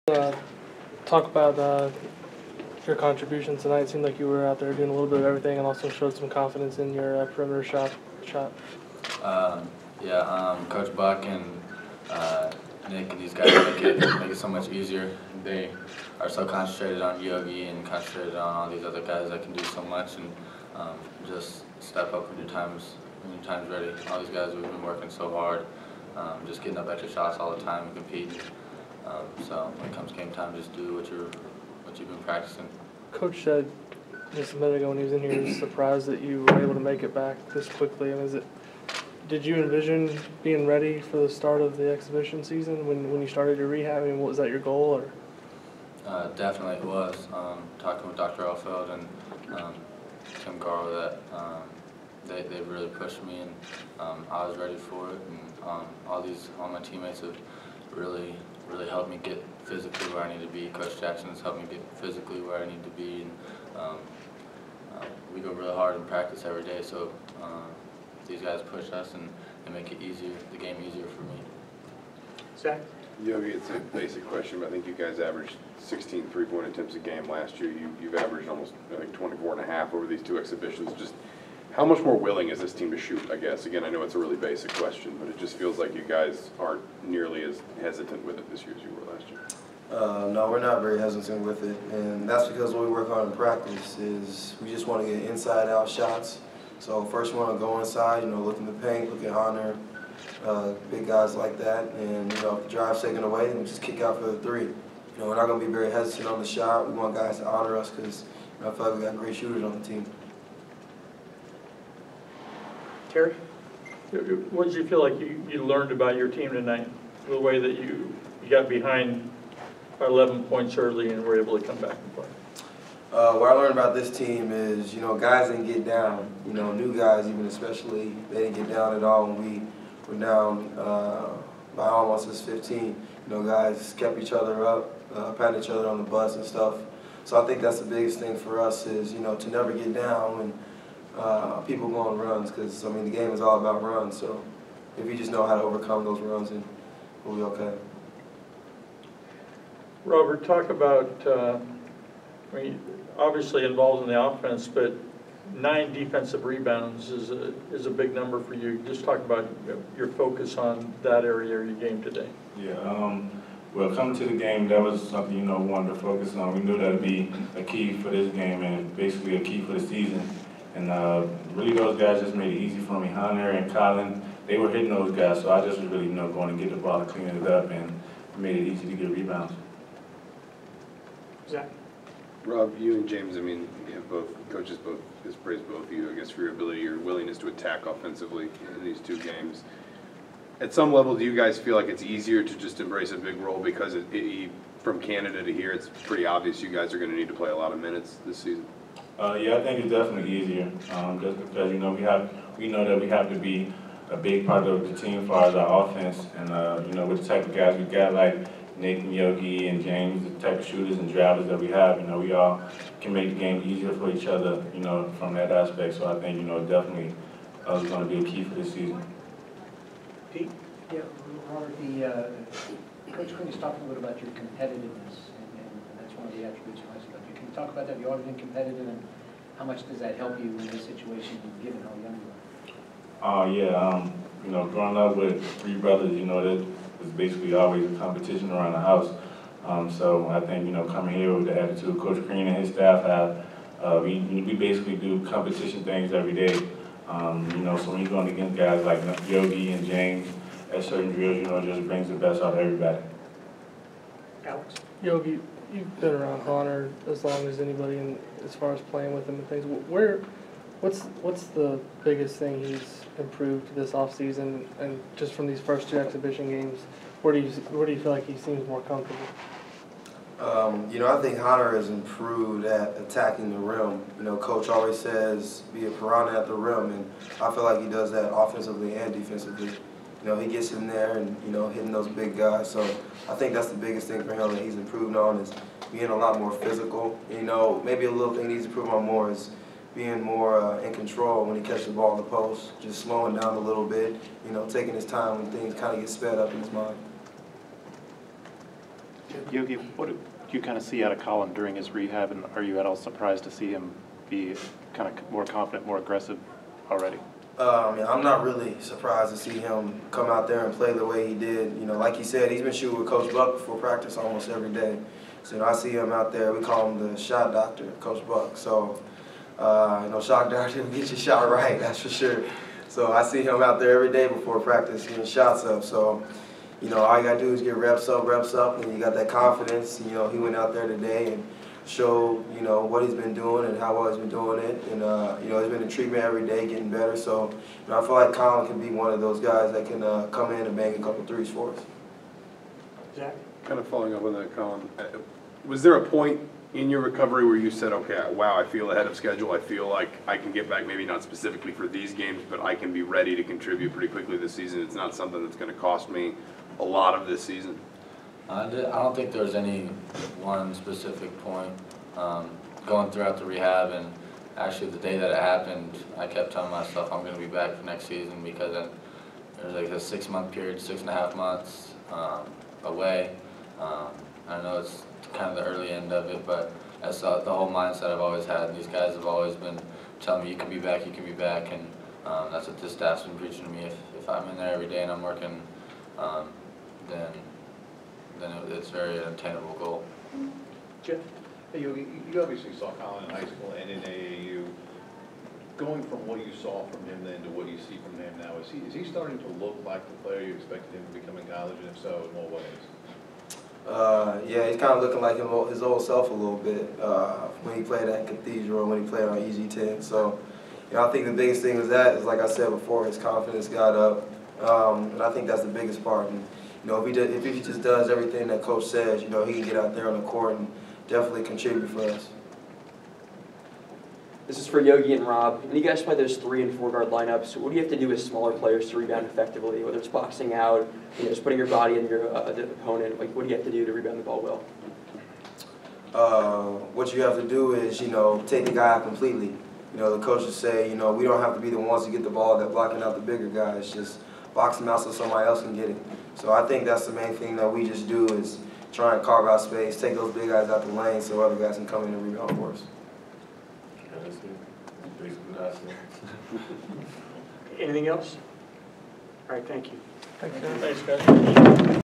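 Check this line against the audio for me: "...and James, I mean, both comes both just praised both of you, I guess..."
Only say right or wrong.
wrong.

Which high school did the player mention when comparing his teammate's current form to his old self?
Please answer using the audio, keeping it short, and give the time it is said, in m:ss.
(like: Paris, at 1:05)
Cathedral, at 6:48.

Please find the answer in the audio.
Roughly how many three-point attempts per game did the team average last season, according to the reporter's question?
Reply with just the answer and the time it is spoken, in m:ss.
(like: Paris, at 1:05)
16, at 1:15.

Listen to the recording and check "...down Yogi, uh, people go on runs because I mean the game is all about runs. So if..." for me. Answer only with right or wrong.
wrong.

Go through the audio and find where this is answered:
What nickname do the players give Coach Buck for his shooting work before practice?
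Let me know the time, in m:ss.
5:17.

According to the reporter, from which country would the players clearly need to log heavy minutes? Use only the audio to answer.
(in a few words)
Canada.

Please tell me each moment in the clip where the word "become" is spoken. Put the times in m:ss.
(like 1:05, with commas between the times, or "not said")
6:41.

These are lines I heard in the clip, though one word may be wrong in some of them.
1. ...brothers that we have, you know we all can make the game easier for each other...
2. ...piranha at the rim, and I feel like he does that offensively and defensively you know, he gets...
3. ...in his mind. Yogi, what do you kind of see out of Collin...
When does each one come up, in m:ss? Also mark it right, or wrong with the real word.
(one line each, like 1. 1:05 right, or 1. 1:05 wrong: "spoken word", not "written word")
1. 3:31 wrong: "drivers", not "brothers"
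2. 4:35 right
3. 4:56 right.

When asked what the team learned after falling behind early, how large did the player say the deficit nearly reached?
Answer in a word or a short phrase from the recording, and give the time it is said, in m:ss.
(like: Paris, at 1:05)
15, at 2:12.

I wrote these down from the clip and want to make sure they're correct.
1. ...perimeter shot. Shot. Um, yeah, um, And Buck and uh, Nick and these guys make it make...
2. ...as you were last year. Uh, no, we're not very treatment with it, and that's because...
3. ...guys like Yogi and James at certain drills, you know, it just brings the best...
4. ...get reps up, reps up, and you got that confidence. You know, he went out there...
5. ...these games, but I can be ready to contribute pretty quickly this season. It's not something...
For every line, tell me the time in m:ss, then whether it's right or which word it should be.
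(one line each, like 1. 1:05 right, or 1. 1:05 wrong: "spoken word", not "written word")
1. 0:07 wrong: "Coach", not "And"
2. 1:28 wrong: "hesitant", not "treatment"
3. 4:08 right
4. 5:27 right
5. 5:51 right.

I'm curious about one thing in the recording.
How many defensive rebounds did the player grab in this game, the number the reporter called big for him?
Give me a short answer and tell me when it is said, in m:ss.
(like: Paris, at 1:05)
9, at 2:35.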